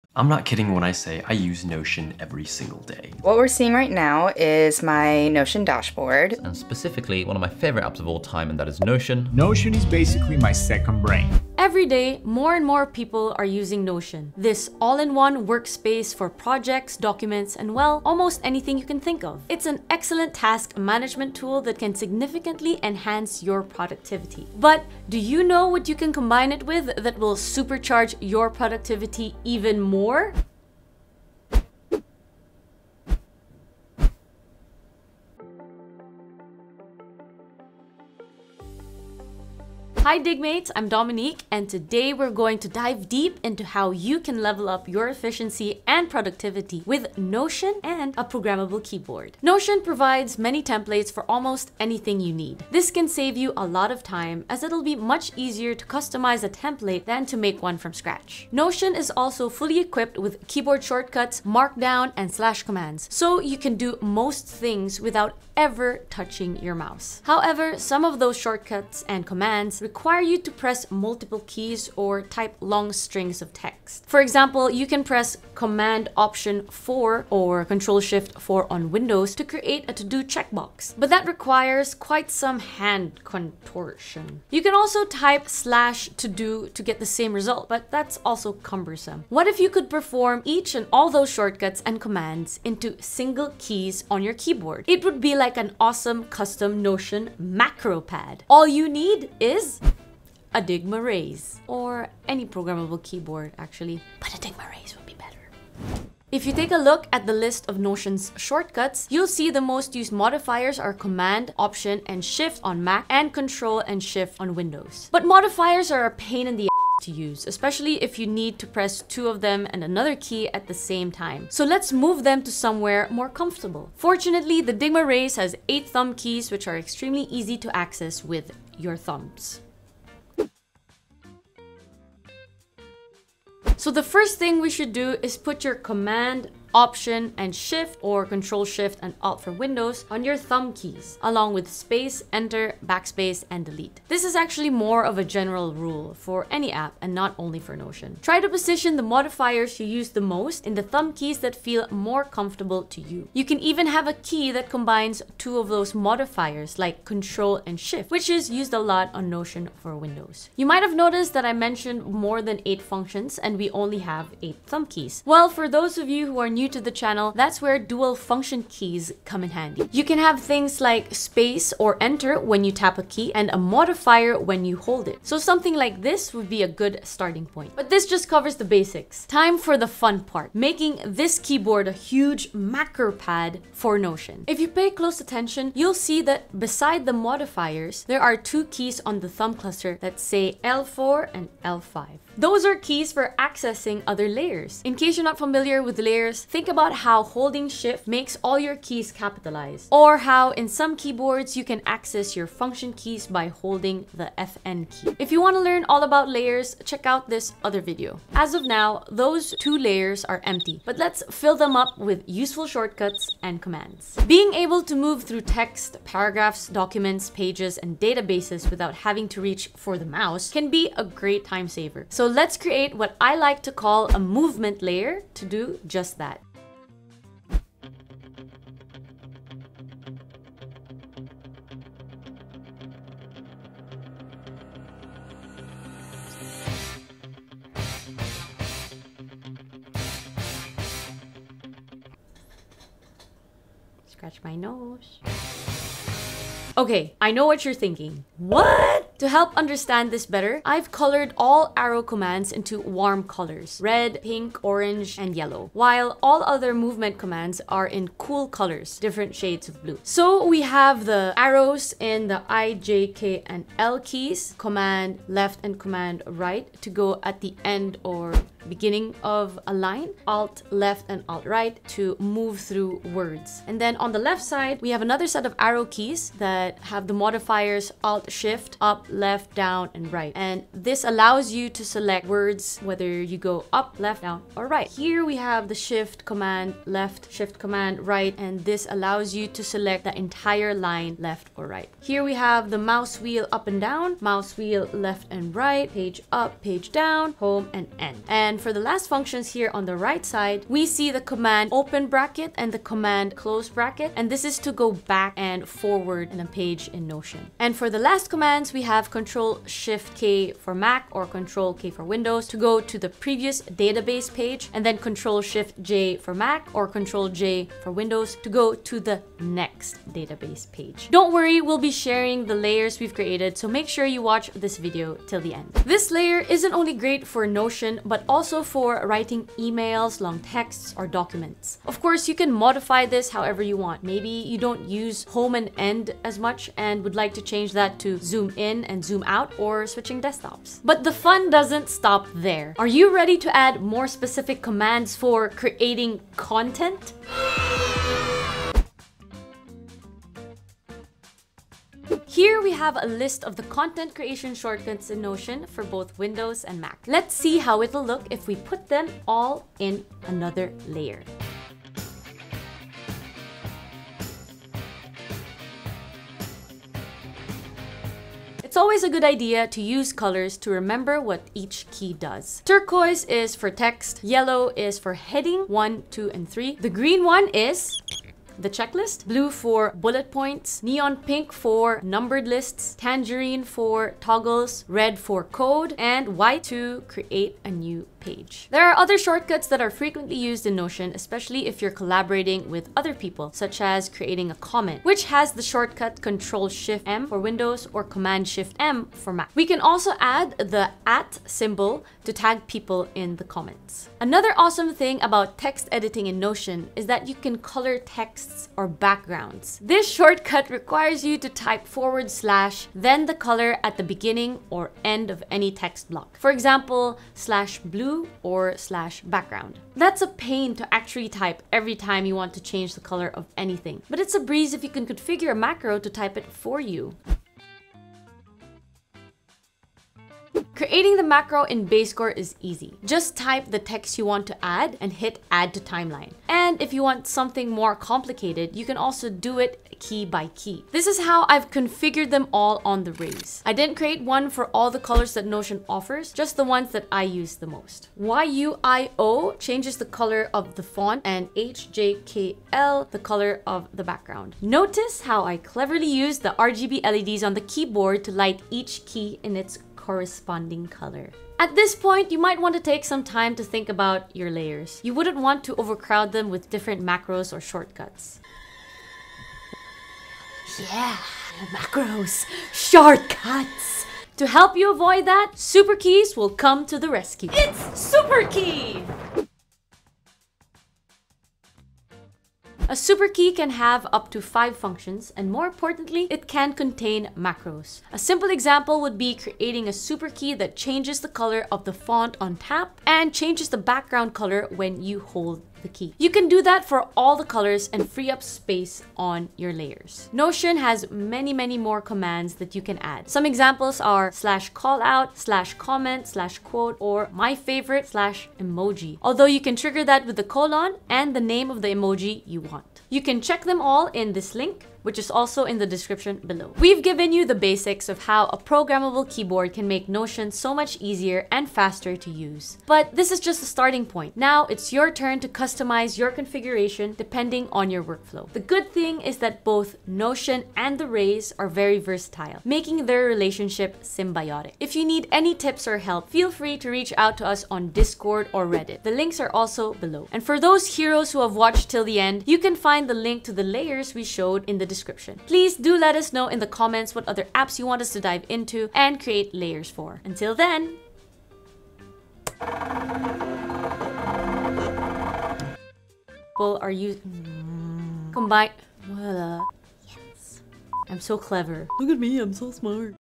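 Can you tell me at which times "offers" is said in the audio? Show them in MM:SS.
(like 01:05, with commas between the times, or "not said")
07:25.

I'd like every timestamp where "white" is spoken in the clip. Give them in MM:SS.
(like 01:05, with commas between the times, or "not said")
06:26.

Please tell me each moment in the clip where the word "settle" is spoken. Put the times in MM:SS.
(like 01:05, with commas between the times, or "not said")
not said.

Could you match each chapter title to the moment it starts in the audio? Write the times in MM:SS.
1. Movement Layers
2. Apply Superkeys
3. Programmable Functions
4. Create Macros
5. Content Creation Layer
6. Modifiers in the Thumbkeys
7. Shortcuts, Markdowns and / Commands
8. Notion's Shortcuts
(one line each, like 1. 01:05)
1. 03:43
2. 07:57
3. 02:45
4. 07:06
5. 05:48
6. 02:09
7. 00:57
8. 01:46.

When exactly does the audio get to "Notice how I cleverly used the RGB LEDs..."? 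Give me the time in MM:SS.
07:34.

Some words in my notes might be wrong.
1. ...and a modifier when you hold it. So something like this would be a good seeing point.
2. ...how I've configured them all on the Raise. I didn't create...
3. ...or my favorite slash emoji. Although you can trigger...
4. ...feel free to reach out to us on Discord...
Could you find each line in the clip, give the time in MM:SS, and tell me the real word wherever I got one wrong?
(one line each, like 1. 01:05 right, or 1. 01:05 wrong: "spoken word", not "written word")
1. 02:53 wrong: "starting", not "seeing"
2. 07:21 right
3. 08:26 right
4. 08:56 right.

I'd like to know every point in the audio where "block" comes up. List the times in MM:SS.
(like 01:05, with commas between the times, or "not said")
06:56.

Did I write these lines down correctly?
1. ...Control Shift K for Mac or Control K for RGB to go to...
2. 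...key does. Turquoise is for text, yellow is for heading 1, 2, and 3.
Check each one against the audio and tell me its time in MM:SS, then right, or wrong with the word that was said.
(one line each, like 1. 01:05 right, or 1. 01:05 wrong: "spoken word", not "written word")
1. 05:09 wrong: "Windows", not "RGB"
2. 06:11 right.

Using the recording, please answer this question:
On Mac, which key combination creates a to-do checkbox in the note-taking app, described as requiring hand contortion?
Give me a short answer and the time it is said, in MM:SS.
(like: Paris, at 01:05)
Command Option 4, at 01:15.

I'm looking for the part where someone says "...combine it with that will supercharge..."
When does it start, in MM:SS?
00:26.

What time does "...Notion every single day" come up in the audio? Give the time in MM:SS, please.
00:01.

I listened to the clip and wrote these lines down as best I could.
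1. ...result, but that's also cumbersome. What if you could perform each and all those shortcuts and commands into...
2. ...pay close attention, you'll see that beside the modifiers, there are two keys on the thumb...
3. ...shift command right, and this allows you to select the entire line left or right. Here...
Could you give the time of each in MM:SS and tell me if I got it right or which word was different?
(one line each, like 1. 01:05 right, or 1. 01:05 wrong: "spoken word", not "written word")
1. 01:27 right
2. 03:04 right
3. 04:47 right.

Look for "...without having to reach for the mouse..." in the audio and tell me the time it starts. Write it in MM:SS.
03:38.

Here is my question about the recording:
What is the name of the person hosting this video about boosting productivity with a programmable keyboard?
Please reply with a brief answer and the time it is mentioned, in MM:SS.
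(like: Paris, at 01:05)
Dominique, at 00:40.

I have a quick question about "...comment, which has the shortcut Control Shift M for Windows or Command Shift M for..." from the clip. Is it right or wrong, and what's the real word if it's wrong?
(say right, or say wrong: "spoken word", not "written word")
right.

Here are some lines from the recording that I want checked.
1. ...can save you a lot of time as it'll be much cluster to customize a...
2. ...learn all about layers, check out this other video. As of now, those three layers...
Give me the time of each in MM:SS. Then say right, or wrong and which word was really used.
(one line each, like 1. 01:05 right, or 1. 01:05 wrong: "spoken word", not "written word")
1. 00:52 wrong: "easier", not "cluster"
2. 03:25 wrong: "two", not "three".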